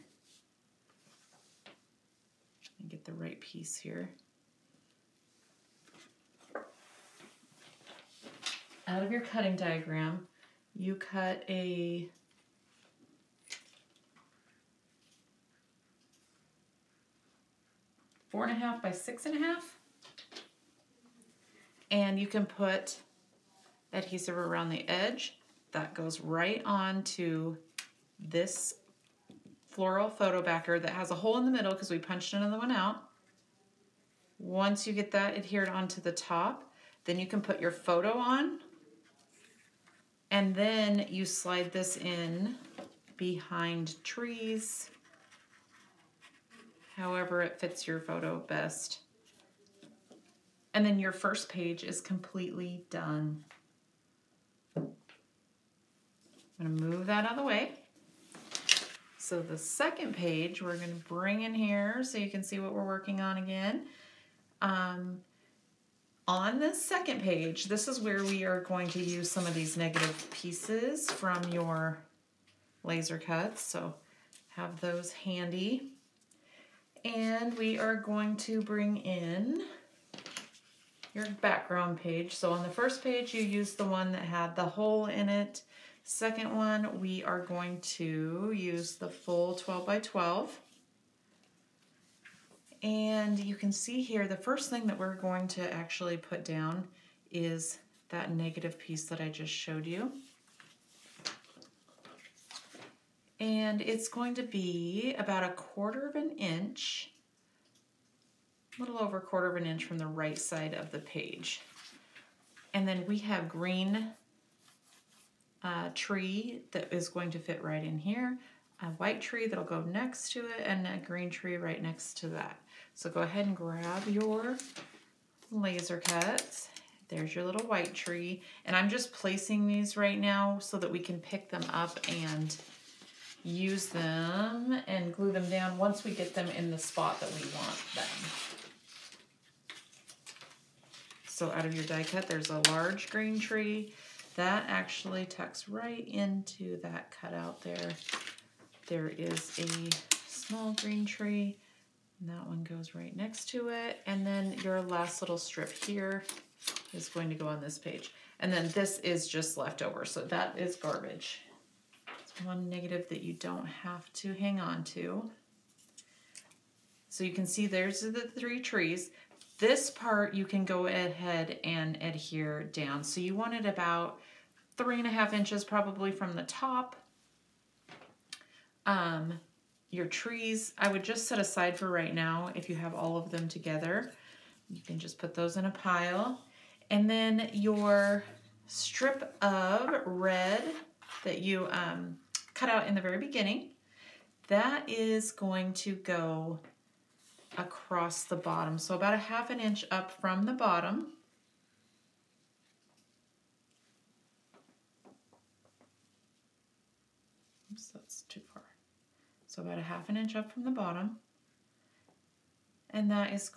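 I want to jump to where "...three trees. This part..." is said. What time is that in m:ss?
2:48.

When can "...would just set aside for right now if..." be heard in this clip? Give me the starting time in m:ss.
3:00.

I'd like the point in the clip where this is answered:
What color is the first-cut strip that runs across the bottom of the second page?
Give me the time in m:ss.
3:10.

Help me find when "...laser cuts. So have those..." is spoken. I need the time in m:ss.
1:12.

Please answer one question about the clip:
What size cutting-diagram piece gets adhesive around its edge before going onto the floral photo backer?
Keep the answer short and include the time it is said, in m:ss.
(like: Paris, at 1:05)
4.5 by 6.5, at 0:18.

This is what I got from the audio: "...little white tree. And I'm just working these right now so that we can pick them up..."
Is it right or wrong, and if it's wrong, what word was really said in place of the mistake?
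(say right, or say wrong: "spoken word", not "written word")
wrong: "placing", not "working".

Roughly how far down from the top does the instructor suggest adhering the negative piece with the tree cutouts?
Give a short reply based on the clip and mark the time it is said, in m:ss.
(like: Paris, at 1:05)
3.5 inches, at 2:54.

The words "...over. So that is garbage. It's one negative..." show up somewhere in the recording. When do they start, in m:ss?
2:39.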